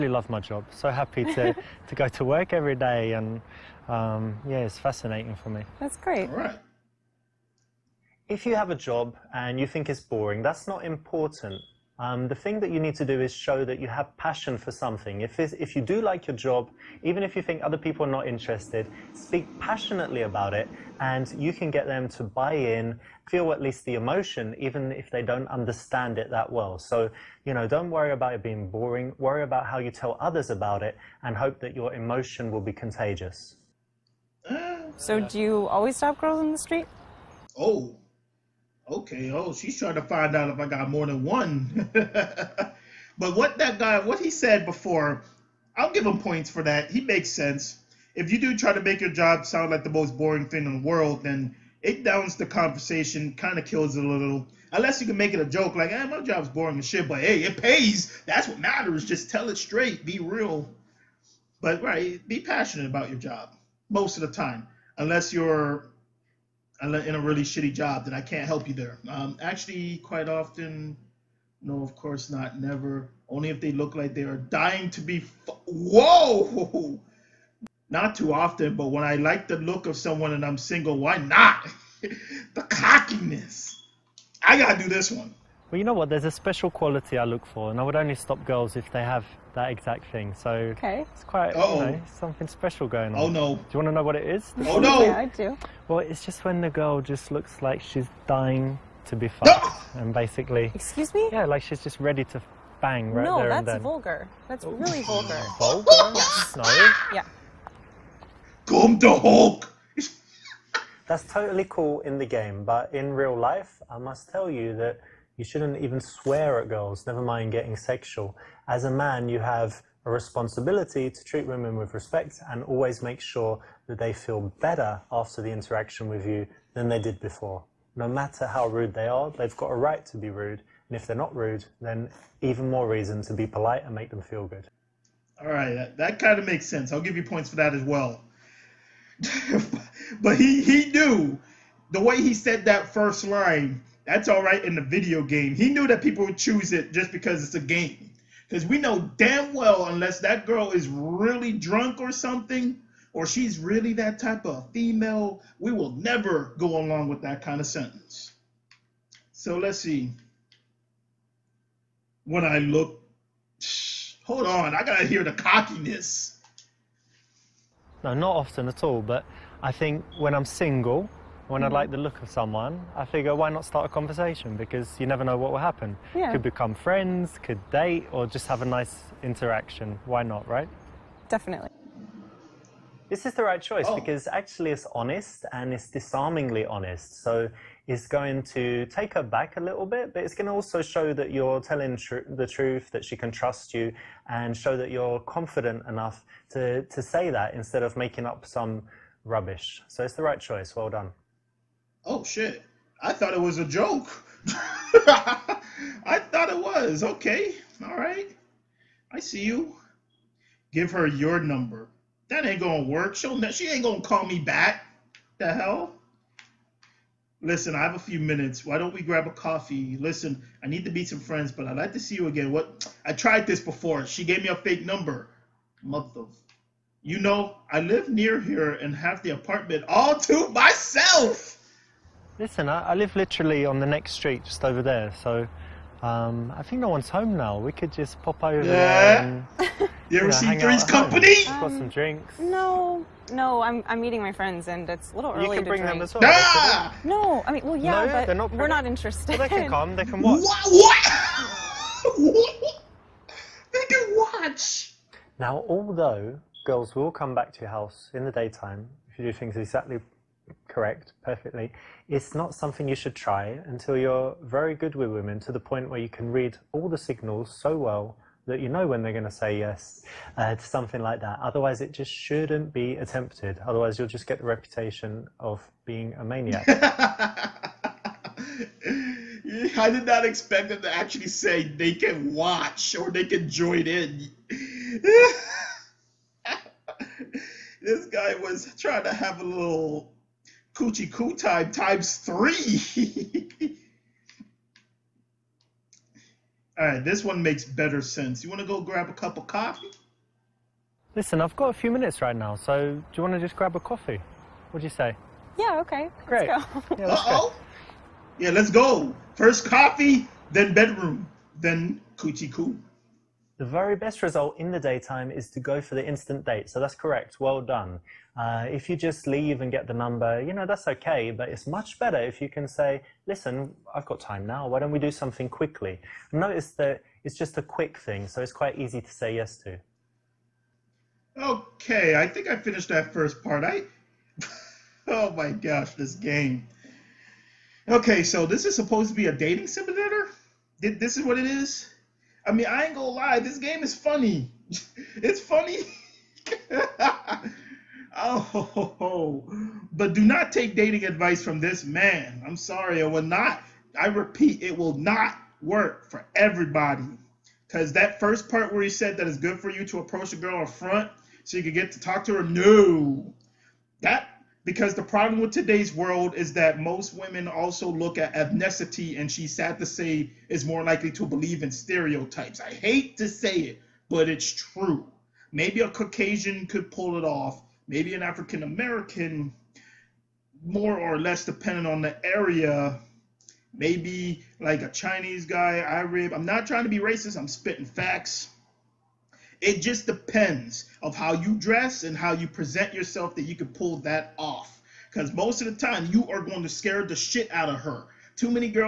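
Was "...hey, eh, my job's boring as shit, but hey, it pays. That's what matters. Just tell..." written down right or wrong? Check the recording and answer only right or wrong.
right.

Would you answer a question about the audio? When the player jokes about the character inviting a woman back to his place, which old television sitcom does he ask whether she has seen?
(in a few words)
Three's Company.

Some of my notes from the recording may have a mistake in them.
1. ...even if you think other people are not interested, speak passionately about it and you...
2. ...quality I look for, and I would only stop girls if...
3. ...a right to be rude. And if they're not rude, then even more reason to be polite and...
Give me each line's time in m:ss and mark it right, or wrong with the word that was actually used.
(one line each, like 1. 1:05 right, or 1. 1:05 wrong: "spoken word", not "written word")
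1. 0:17 right
2. 1:26 right
3. 2:09 right.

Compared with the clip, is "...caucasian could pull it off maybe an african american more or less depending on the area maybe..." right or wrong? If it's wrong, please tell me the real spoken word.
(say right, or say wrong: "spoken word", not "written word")
right.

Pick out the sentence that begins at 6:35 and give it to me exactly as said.
Because most of the time, you are going to scare the shit out of her.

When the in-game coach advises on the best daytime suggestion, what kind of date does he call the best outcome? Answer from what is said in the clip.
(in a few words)
instant date.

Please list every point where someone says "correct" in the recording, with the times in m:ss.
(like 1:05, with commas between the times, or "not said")
4:20, 5:16.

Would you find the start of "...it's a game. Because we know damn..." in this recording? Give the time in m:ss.
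2:27.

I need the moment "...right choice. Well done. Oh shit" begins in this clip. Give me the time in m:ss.
3:20.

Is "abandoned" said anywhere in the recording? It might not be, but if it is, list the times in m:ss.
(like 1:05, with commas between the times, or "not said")
not said.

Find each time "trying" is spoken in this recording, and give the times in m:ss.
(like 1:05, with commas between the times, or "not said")
0:39, 4:48, 6:26.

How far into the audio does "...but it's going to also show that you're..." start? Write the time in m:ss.
3:10.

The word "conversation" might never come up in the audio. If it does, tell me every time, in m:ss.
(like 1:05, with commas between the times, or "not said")
0:52, 2:53.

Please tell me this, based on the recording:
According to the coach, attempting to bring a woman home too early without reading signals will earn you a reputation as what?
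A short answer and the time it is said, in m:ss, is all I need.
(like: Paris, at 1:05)
a maniac, at 4:36.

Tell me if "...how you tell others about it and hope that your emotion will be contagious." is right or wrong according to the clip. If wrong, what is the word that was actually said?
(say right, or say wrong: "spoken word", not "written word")
right.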